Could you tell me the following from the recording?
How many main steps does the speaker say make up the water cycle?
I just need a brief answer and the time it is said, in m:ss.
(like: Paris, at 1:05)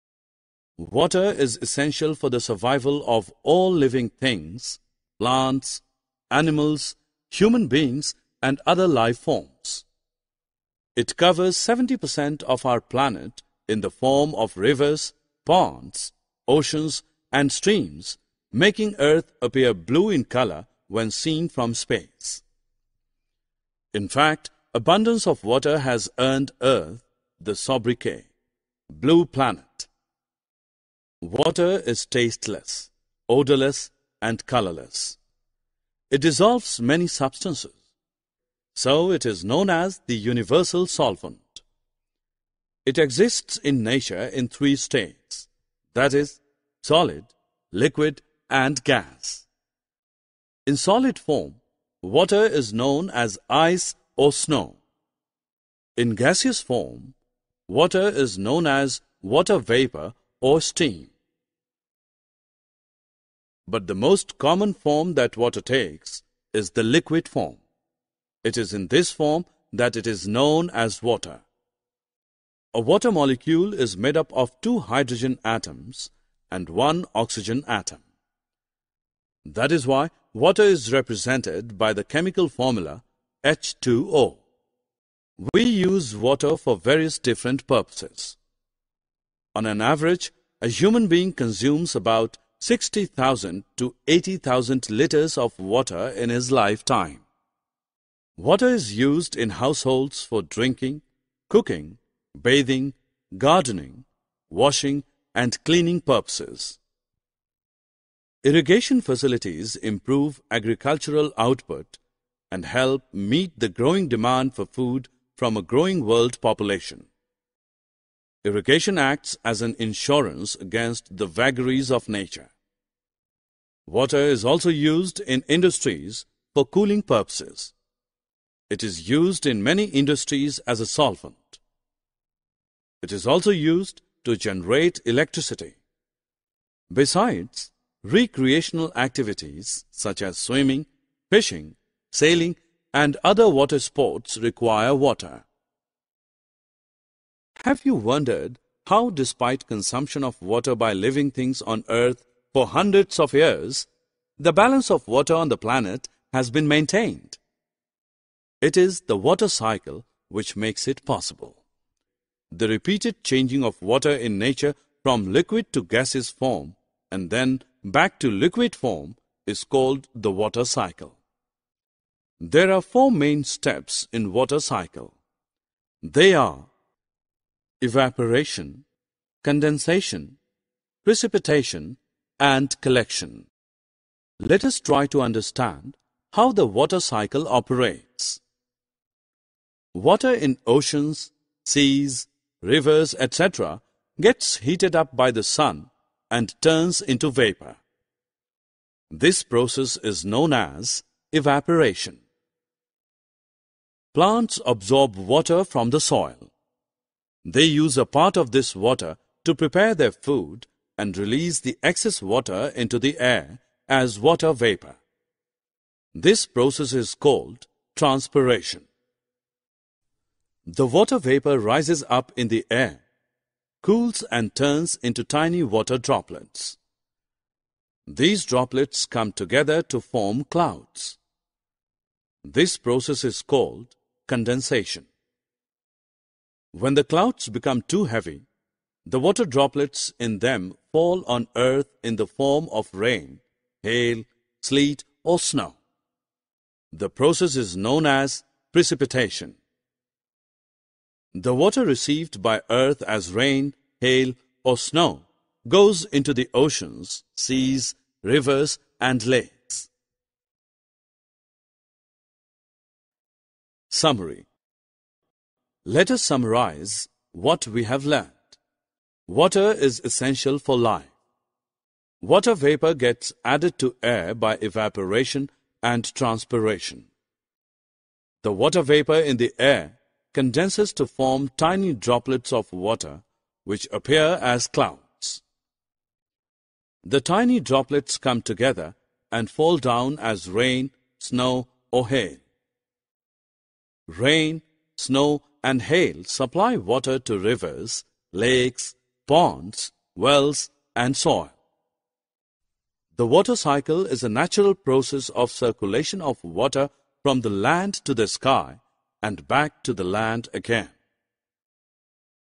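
4, at 2:52.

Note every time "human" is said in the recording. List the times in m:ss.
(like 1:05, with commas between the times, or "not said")
0:07, 1:30.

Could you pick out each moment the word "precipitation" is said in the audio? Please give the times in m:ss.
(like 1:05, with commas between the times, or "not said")
3:01, 4:08.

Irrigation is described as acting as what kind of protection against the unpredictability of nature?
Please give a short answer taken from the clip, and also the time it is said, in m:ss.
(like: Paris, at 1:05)
An insurance, at 1:59.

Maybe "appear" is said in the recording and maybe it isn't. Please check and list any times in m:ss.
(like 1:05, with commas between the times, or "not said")
0:19, 4:43.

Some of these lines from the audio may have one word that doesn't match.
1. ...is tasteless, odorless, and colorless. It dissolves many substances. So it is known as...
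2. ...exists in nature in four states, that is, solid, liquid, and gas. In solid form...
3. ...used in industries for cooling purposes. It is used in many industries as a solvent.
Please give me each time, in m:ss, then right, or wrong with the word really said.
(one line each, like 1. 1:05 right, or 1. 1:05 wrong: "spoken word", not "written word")
1. 0:31 right
2. 0:42 wrong: "three", not "four"
3. 2:04 right.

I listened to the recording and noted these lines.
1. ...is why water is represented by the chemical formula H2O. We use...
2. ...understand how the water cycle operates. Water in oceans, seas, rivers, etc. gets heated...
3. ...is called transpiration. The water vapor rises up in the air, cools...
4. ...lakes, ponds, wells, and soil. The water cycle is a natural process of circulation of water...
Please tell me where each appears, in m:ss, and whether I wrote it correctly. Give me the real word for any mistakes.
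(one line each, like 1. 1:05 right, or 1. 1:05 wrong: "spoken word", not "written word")
1. 1:19 right
2. 3:05 right
3. 3:36 right
4. 4:58 right.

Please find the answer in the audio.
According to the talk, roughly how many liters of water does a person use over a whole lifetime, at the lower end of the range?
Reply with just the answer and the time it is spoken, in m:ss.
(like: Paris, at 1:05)
60,000 liters, at 1:32.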